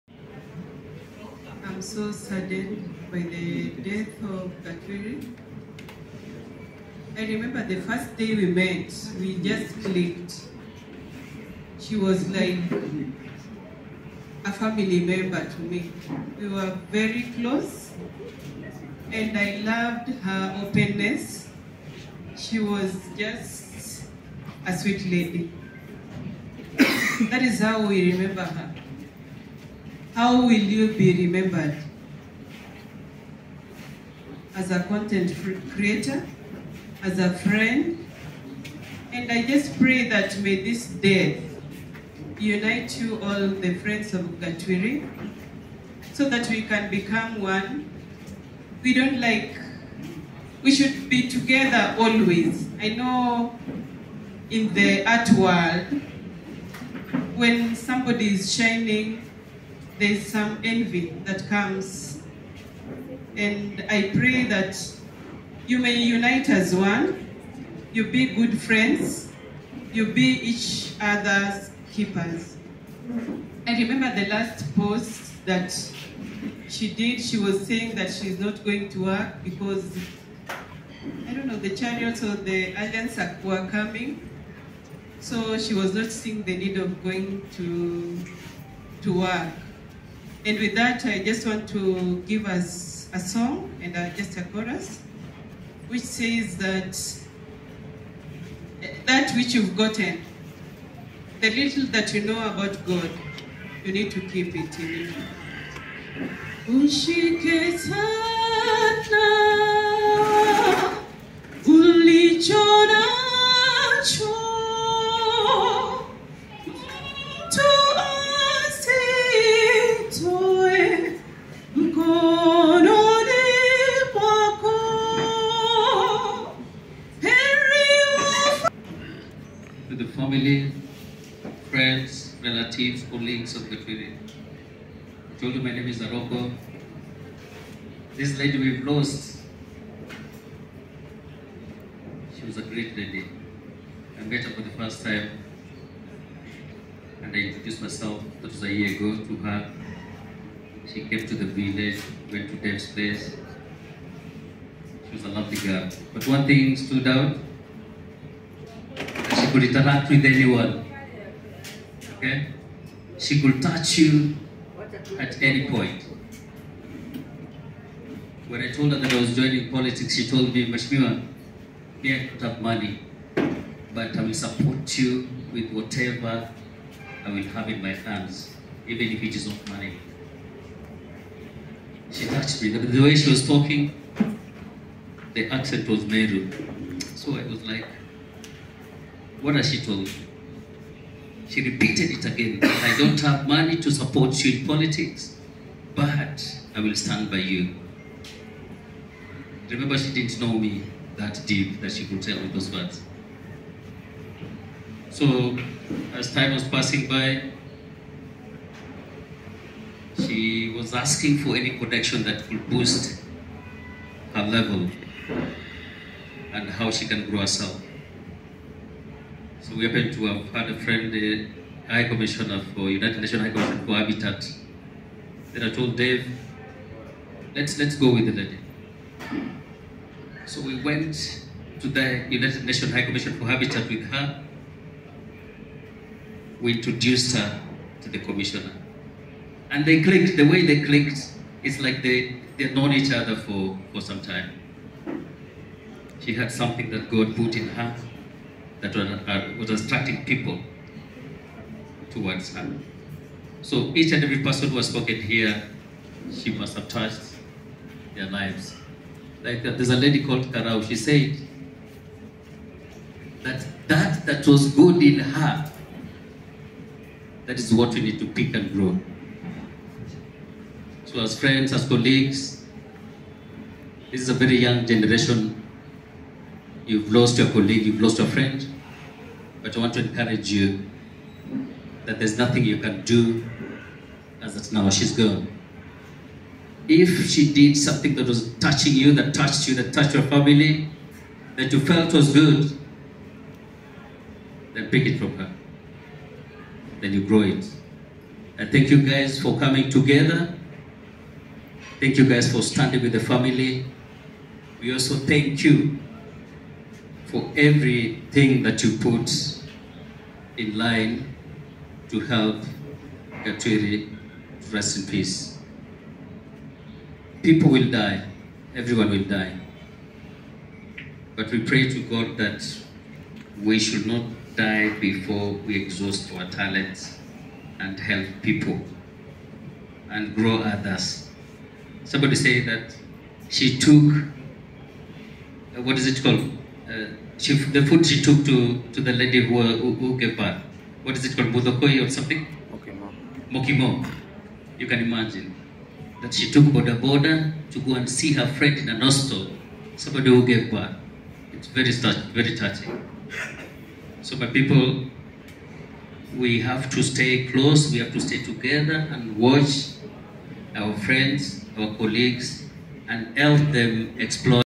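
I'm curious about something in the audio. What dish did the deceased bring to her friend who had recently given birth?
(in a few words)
Mokimo.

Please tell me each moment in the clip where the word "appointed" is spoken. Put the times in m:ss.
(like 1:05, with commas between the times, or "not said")
not said.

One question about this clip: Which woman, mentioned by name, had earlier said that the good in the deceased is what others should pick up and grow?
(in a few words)
Karau.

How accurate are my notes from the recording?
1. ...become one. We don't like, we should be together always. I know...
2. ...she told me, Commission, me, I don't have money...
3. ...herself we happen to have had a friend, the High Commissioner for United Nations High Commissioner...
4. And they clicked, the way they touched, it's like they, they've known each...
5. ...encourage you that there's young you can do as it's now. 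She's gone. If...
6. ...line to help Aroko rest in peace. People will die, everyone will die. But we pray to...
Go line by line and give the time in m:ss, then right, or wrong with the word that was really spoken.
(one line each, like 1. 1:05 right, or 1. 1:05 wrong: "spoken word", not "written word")
1. 0:46 right
2. 2:50 wrong: "Mashmiwa", not "Commission"
3. 3:37 right
4. 3:59 wrong: "clicked", not "touched"
5. 4:39 wrong: "nothing", not "young"
6. 5:10 wrong: "Gatwiri", not "Aroko".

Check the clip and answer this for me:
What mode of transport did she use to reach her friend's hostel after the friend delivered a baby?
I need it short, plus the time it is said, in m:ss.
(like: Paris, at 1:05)
boda boda, at 5:46.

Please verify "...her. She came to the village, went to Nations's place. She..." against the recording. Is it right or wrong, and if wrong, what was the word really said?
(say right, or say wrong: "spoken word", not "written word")
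wrong: "Dave", not "Nations".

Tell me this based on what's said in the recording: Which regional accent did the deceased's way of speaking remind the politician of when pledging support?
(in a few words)
Meru.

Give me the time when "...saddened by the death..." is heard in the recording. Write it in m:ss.
0:02.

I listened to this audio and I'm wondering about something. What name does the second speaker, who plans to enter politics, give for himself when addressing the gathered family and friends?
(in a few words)
Aroko.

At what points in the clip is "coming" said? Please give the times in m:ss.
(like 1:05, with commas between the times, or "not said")
1:23, 4:59.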